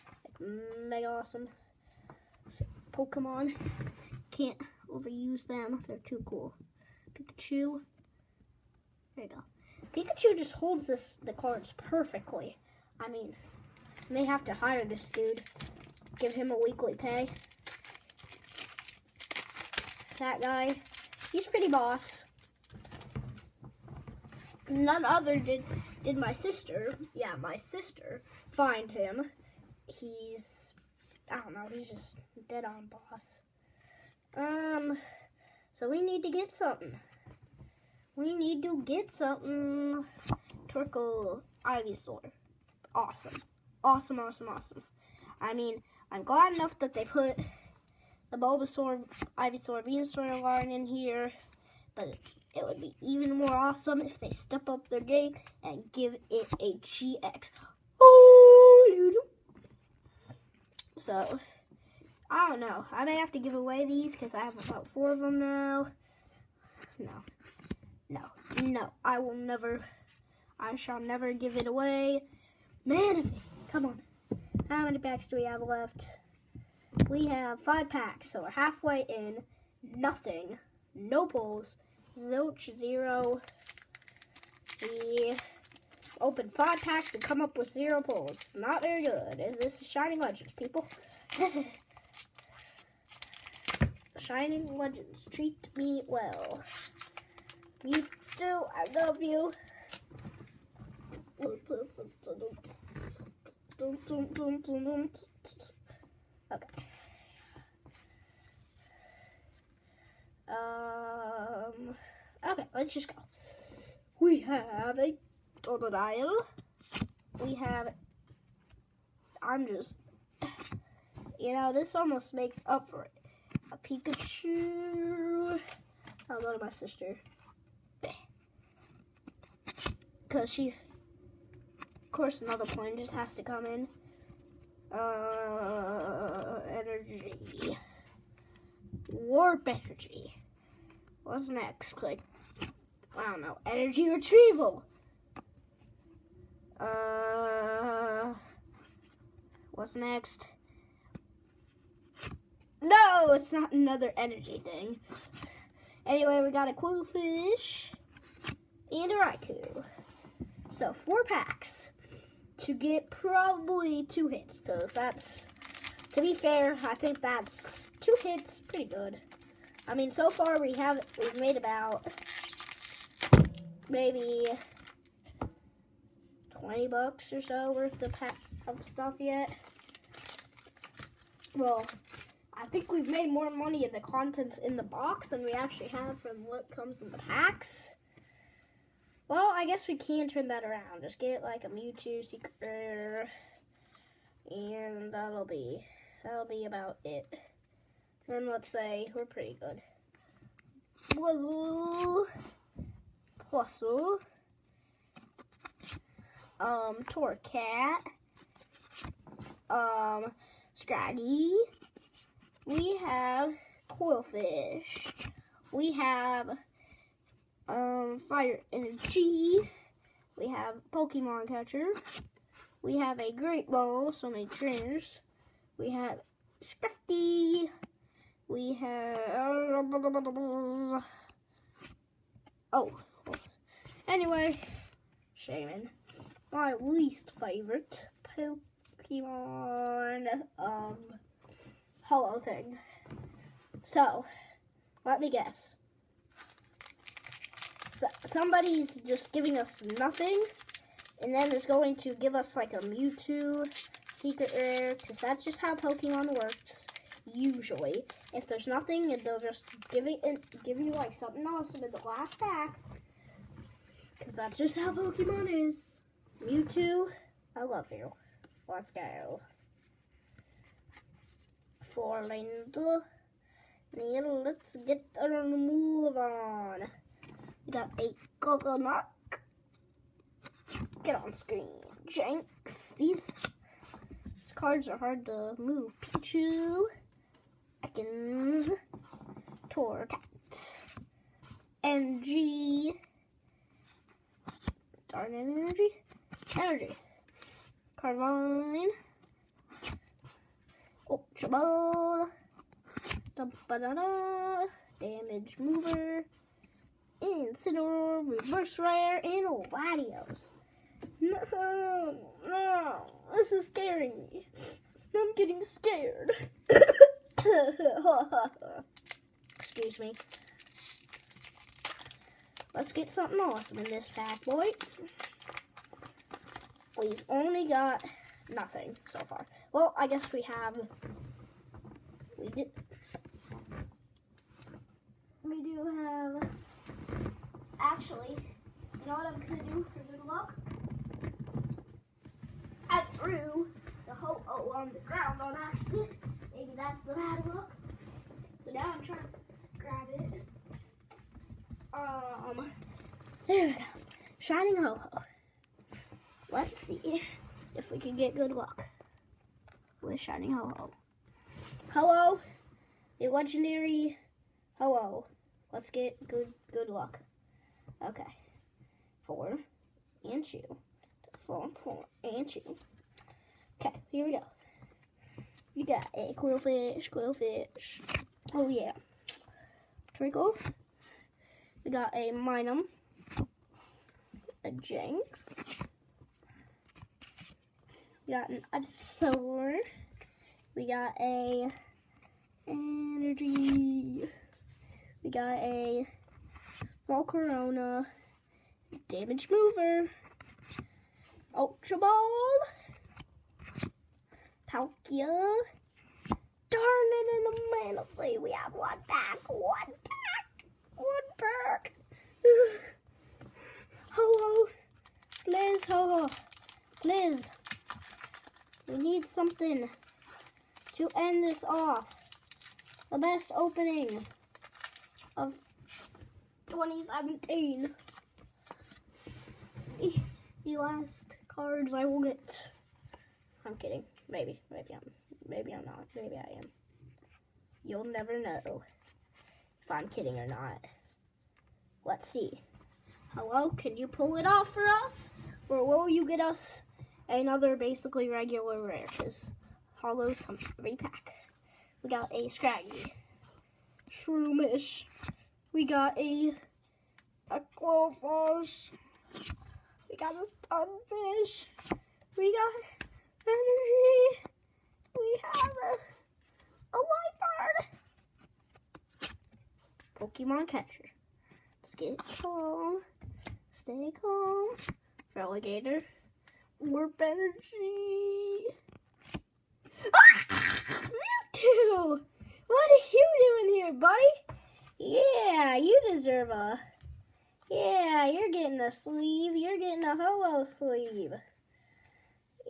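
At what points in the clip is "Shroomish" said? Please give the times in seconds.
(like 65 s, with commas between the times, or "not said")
454 s.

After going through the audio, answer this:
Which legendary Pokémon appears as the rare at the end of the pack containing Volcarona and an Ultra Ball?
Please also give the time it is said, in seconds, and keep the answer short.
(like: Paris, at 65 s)
Palkia, at 404 s.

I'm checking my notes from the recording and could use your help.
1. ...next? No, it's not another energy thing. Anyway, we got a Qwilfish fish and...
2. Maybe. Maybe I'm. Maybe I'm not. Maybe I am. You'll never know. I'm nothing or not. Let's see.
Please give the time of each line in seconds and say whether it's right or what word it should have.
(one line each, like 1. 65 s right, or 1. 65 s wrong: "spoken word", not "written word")
1. 149 s right
2. 434 s wrong: "kidding", not "nothing".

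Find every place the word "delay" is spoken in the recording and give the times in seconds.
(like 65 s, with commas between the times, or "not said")
not said.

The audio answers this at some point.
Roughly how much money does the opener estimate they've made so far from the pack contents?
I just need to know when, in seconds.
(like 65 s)
176 s.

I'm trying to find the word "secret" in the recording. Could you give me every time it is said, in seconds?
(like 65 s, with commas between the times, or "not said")
192 s, 254 s.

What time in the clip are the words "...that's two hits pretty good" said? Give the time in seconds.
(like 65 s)
167 s.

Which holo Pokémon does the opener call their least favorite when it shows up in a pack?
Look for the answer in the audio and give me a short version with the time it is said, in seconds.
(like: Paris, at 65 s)
Shaymin, at 235 s.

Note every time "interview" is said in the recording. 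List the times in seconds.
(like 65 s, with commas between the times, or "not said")
not said.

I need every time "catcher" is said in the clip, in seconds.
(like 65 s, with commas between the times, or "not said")
221 s, 470 s.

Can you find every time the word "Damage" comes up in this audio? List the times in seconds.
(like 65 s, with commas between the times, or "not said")
304 s, 399 s.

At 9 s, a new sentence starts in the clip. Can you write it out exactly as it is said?
Pikachu just holds this the cards perfectly.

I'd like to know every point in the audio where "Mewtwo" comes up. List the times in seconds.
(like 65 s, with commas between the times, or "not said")
191 s, 252 s, 266 s, 481 s.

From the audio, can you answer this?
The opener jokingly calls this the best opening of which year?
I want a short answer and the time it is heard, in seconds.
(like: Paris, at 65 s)
2017, at 426 s.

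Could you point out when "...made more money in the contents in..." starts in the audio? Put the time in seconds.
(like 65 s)
183 s.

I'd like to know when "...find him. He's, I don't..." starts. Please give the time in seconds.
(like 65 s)
28 s.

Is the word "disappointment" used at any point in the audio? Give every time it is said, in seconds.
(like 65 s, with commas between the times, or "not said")
not said.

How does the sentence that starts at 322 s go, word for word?
Let's get something awesome in this pack, boy.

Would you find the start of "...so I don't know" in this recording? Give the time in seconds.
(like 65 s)
60 s.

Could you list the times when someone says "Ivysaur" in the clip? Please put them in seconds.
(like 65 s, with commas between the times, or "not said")
41 s, 49 s, 388 s.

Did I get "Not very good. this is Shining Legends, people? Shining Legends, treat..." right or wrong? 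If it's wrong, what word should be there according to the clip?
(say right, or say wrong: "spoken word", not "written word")
right.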